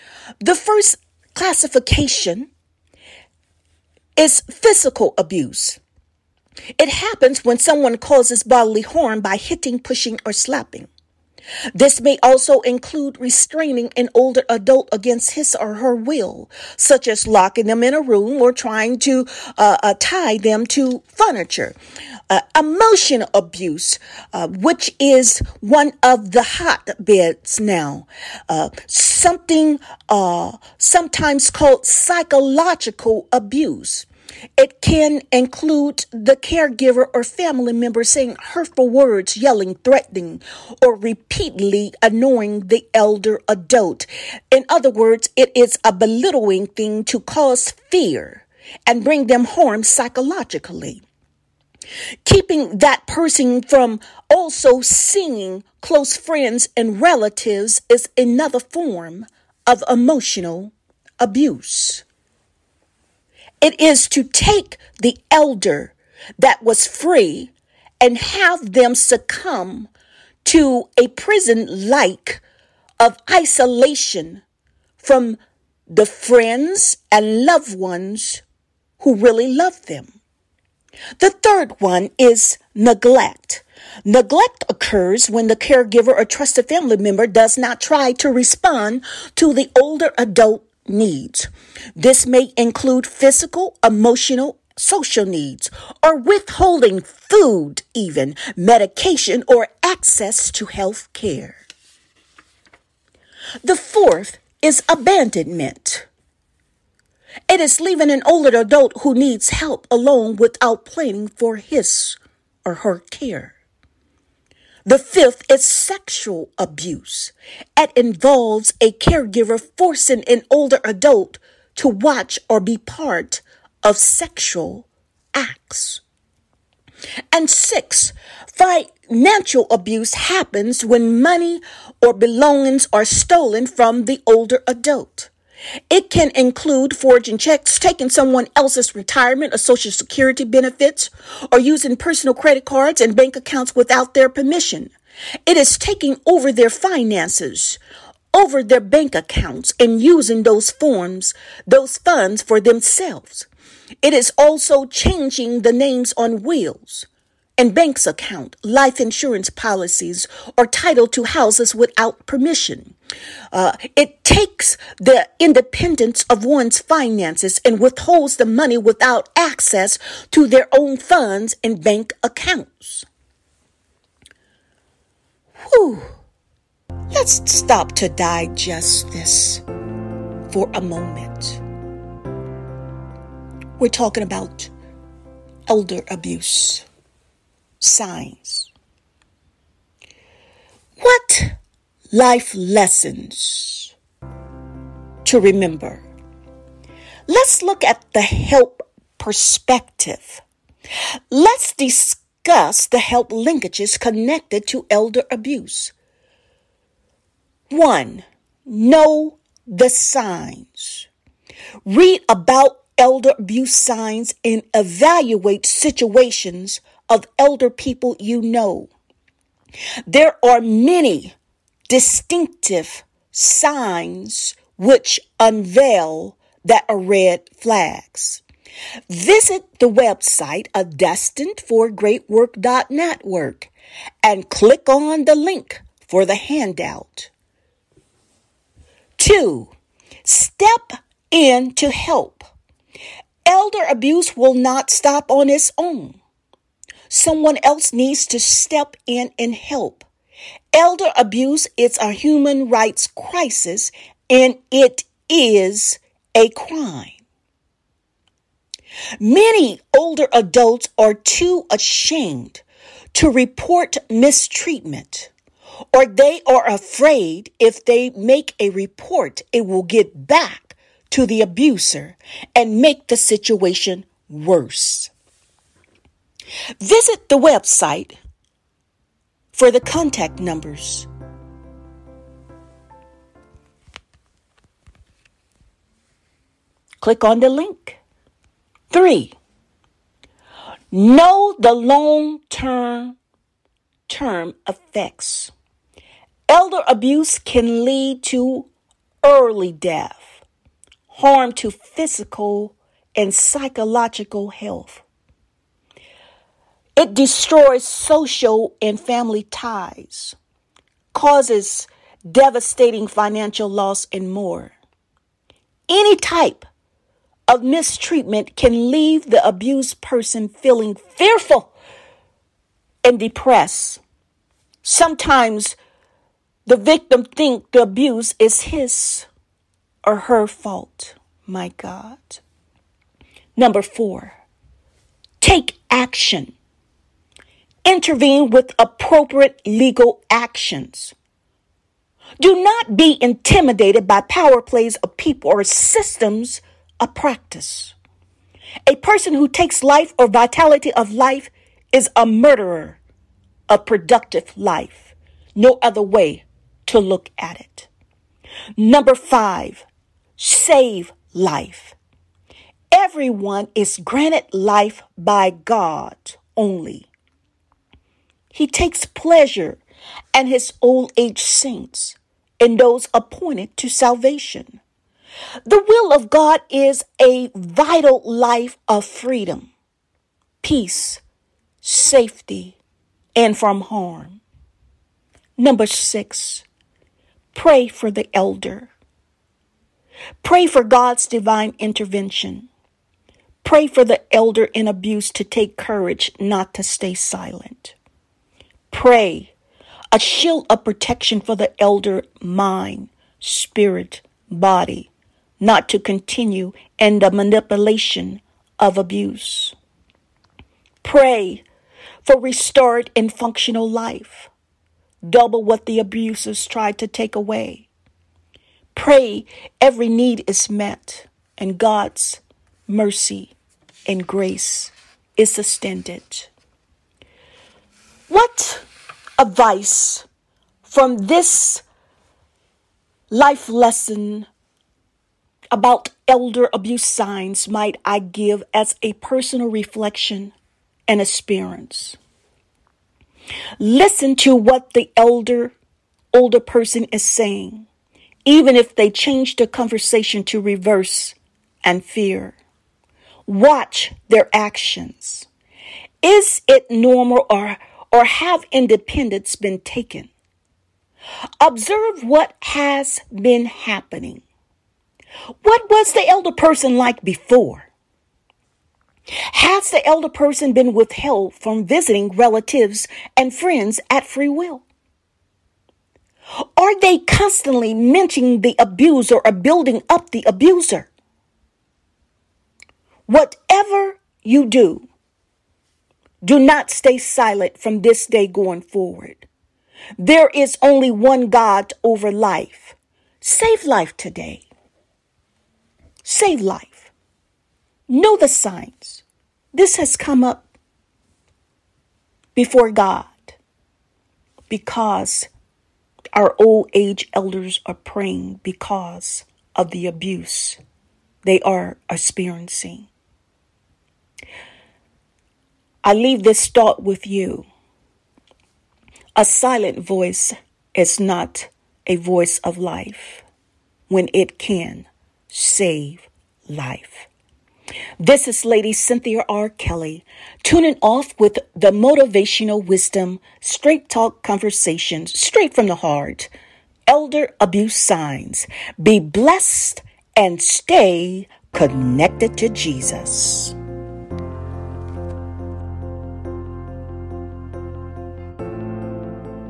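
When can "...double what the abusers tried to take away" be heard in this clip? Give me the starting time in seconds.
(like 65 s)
415 s.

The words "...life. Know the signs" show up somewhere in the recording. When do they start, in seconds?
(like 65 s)
496 s.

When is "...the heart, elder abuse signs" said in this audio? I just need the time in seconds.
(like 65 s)
535 s.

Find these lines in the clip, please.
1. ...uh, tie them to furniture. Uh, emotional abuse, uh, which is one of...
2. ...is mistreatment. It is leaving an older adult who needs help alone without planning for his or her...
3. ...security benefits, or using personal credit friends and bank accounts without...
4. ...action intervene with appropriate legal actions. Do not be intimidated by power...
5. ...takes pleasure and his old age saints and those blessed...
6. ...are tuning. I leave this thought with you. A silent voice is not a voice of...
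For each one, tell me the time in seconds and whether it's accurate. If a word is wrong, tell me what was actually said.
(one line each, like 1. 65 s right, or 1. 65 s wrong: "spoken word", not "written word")
1. 19 s right
2. 104 s wrong: "abandonment", not "mistreatment"
3. 139 s wrong: "cards", not "friends"
4. 335 s right
5. 368 s wrong: "appointed", not "blessed"
6. 511 s wrong: "experiencing", not "tuning".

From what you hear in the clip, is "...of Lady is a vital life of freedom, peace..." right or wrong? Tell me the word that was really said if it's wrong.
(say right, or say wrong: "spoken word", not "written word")
wrong: "God", not "Lady".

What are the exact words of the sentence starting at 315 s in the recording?
Any type of mistreatment can leave the abused person feeling fearful and depressed.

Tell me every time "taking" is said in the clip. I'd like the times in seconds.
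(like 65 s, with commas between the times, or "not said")
137 s, 145 s.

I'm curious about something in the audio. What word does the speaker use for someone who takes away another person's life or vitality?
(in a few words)
Murderer.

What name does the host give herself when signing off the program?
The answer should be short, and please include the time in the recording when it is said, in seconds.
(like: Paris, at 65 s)
Lady Cynthia R. Kelly, at 528 s.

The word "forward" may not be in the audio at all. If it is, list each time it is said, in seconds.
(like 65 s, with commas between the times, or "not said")
488 s.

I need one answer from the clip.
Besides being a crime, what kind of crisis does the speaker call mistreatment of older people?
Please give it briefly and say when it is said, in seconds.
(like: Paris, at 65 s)
Human rights crisis, at 252 s.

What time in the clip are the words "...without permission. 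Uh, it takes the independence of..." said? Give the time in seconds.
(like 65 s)
161 s.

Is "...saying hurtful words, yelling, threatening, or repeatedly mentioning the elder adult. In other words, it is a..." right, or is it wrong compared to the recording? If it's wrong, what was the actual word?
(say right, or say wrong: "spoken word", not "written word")
wrong: "annoying", not "mentioning".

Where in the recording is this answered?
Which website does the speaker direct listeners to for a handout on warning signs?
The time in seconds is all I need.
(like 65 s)
230 s.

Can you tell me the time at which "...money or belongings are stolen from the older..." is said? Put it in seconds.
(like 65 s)
131 s.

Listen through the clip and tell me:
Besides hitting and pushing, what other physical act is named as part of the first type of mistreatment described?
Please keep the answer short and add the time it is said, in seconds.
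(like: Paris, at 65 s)
Slapping, at 10 s.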